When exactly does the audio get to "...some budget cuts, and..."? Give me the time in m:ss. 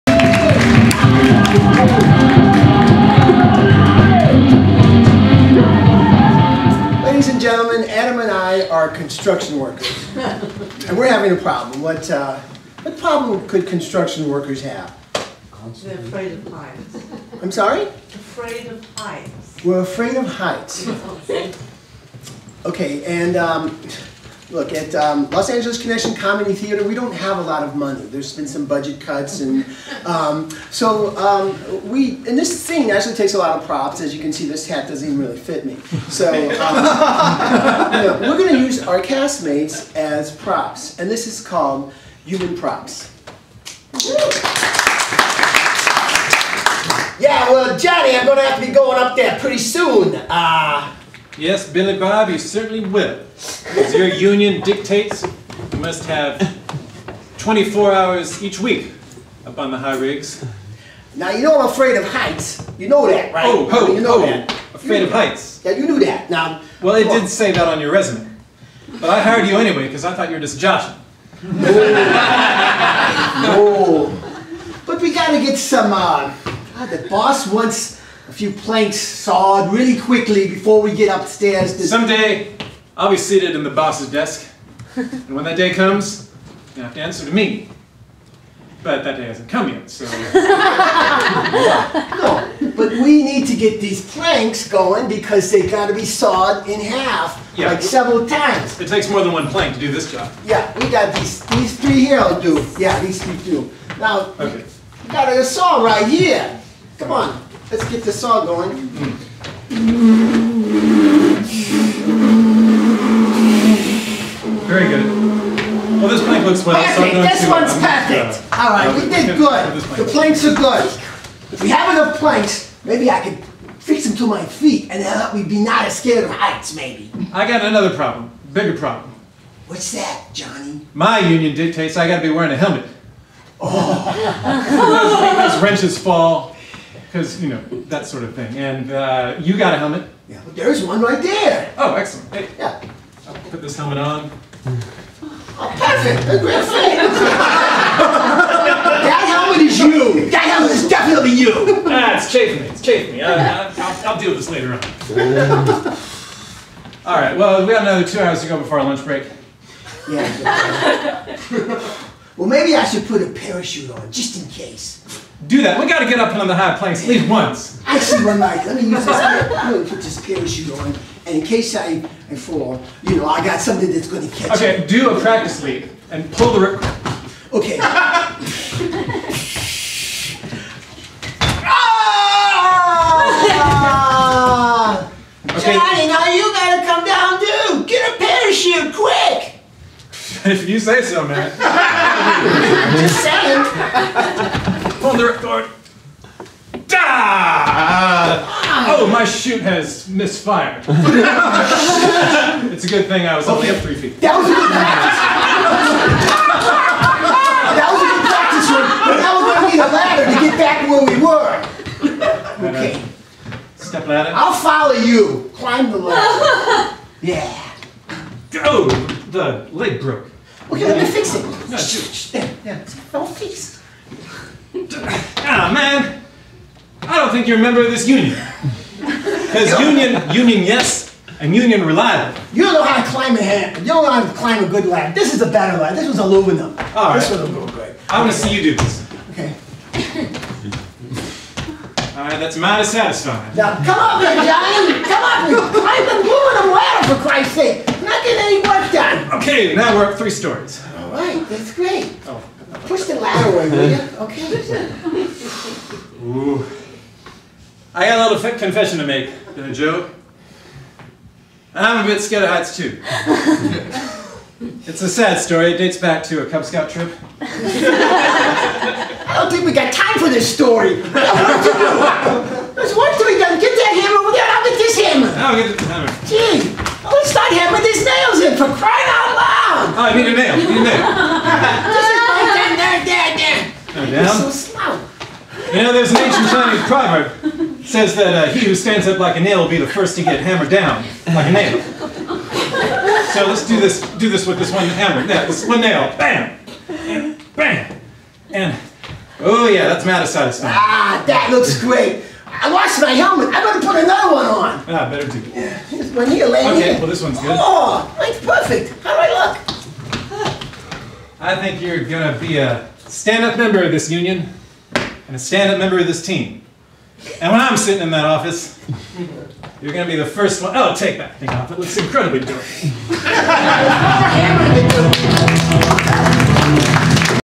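0:28.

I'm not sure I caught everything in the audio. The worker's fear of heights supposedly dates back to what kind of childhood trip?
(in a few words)
Cub Scout trip.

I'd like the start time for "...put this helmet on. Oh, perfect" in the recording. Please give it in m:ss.
2:23.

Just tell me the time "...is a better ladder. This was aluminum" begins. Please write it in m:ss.
3:55.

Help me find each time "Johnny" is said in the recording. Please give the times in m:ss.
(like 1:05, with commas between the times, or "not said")
0:47, 2:10, 3:05, 4:04.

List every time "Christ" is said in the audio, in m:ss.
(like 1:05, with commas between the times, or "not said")
4:07.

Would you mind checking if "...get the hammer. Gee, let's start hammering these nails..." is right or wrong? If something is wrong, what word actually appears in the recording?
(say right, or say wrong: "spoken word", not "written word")
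right.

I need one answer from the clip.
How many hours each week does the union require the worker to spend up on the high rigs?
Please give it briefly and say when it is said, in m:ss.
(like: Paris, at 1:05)
24, at 0:57.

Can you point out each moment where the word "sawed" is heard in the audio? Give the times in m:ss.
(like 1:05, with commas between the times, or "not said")
1:18, 1:36.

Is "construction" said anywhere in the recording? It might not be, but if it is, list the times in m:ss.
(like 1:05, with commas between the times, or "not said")
0:08, 0:13.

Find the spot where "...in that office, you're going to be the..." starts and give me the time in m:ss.
5:18.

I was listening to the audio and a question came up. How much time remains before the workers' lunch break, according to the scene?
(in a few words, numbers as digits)
2 hours.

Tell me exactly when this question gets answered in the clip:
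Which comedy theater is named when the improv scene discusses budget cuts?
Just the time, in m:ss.
0:25.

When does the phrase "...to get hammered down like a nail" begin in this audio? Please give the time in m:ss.
4:50.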